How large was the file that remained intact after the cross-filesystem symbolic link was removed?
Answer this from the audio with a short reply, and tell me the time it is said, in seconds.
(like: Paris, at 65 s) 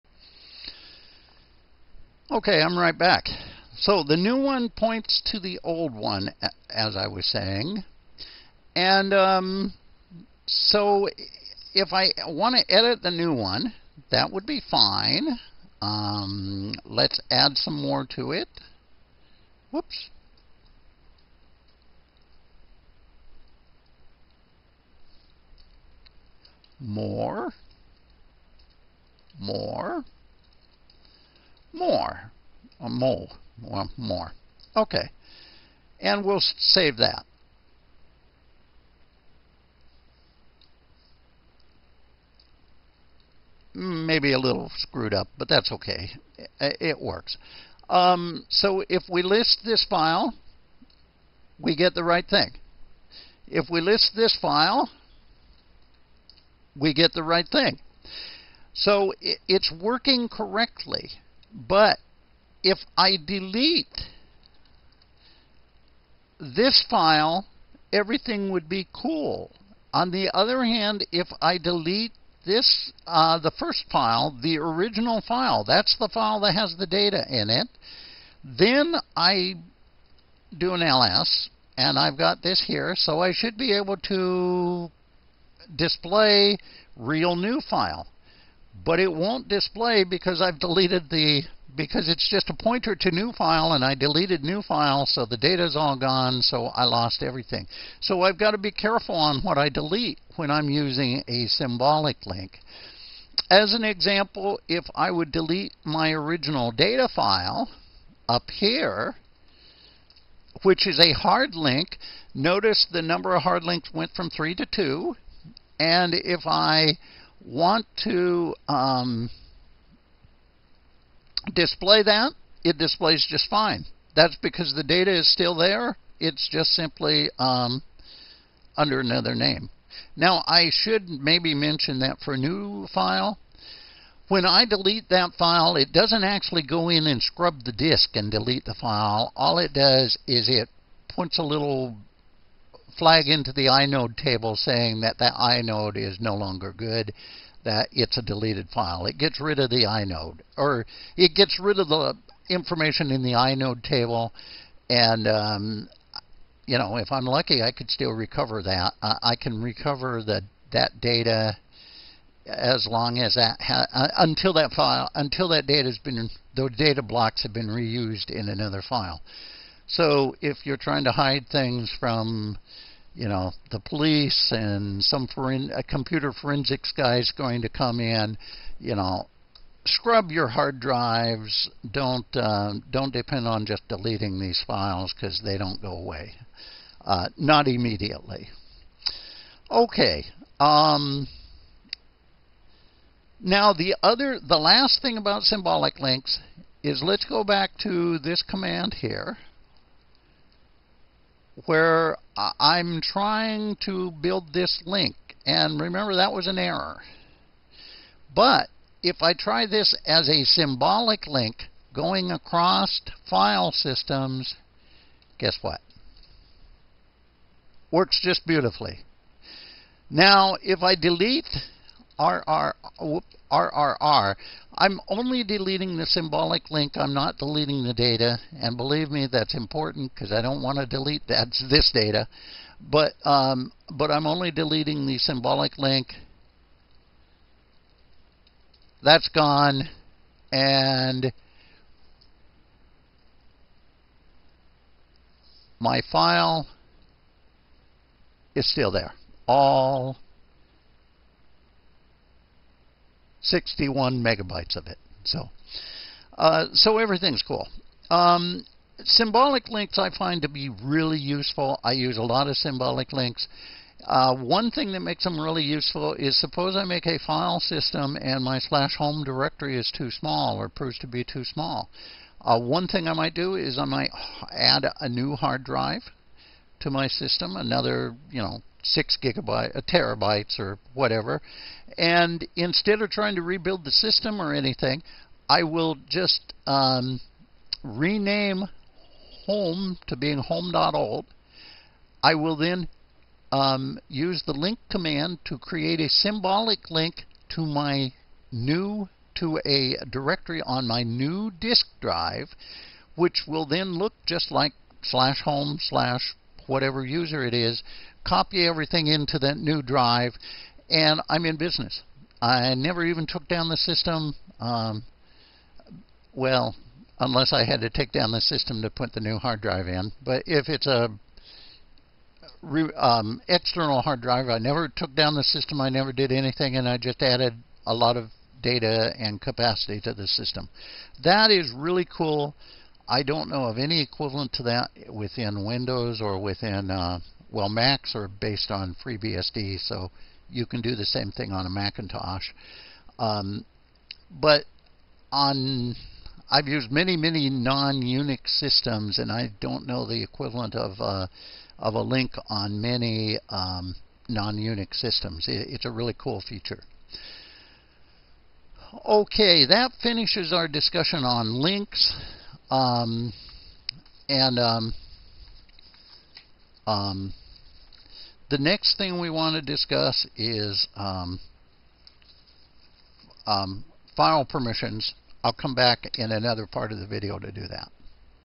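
61 megabytes, at 253 s.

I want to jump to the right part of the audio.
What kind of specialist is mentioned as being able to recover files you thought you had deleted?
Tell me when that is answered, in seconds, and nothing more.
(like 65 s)
175 s.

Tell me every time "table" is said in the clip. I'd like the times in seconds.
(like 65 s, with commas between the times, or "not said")
144 s, 153 s.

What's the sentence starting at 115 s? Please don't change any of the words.
And if I want to um, display that, it displays just fine.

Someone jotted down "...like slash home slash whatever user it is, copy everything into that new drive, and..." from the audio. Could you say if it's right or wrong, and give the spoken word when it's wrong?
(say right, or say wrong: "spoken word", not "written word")
right.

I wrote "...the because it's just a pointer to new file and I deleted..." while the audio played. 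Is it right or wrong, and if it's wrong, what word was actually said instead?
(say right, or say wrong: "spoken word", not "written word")
right.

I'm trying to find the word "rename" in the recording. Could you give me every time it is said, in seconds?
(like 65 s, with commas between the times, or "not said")
287 s.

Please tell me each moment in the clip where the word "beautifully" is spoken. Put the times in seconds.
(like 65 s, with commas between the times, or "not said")
218 s.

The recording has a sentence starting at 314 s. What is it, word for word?
Um, well, unless I had to take down the system to put the new hard drive in.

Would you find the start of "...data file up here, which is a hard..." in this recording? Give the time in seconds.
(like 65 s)
106 s.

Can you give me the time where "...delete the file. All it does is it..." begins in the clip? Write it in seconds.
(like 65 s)
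138 s.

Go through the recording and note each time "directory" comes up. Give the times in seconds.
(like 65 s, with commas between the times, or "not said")
269 s, 300 s.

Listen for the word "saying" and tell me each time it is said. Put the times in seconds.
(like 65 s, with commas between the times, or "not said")
7 s, 144 s.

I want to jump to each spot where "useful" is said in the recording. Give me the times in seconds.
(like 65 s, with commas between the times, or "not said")
261 s, 265 s.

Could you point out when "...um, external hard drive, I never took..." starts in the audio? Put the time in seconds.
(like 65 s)
322 s.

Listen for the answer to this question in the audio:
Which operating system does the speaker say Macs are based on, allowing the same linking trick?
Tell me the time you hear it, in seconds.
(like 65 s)
339 s.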